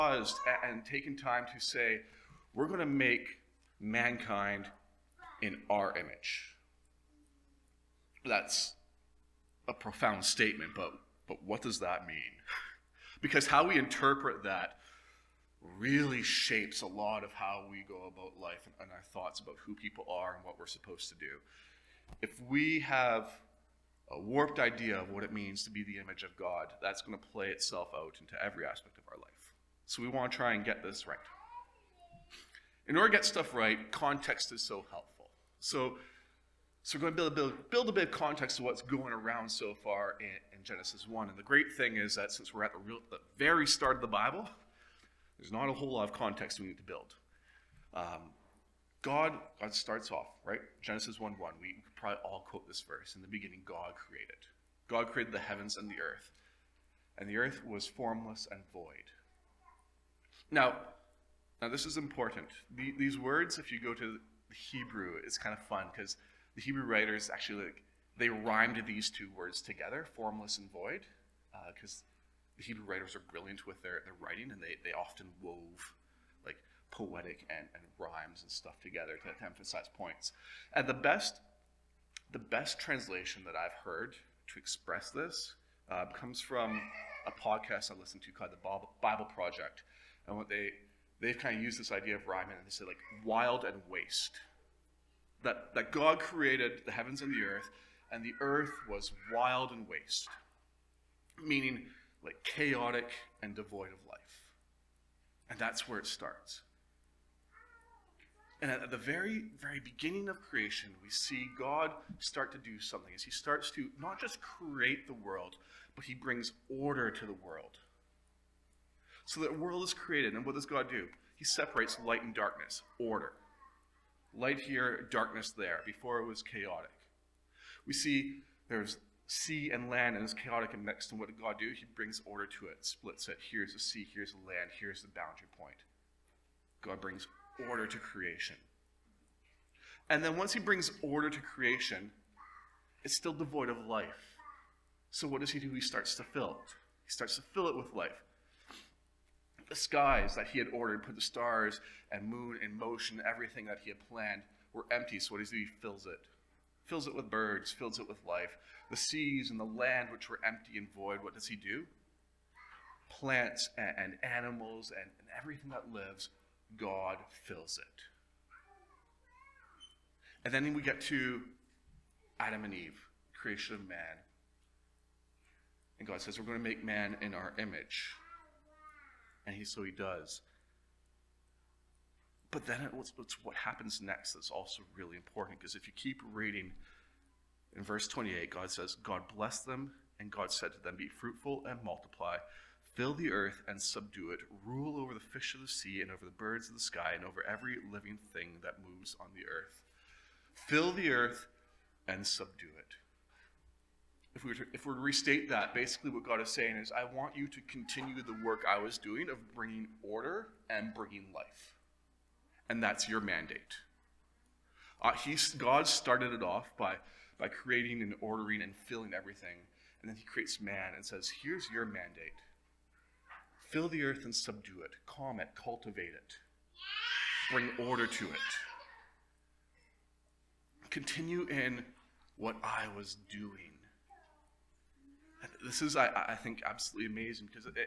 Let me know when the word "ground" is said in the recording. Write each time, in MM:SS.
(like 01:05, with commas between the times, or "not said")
not said.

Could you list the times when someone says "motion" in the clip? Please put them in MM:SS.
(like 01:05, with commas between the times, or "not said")
02:32.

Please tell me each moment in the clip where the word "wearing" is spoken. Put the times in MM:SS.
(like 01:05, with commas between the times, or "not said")
not said.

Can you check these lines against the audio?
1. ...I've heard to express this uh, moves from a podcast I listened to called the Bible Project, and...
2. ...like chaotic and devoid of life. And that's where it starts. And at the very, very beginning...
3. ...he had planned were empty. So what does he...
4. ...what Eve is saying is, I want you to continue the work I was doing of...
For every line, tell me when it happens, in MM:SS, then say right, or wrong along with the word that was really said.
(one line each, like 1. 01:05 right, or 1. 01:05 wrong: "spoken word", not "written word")
1. 01:23 wrong: "comes", not "moves"
2. 01:42 right
3. 02:33 right
4. 03:26 wrong: "God", not "Eve".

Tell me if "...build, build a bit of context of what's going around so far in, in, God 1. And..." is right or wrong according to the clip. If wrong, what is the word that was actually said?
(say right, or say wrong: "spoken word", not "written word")
wrong: "Genesis", not "God".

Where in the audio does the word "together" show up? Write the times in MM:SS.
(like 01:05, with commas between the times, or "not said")
01:09, 01:18.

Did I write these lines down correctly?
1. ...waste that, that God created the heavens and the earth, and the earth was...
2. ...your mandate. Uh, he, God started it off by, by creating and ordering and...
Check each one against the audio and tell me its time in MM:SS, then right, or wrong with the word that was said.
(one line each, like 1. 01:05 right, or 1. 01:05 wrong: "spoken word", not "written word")
1. 01:33 right
2. 03:33 right.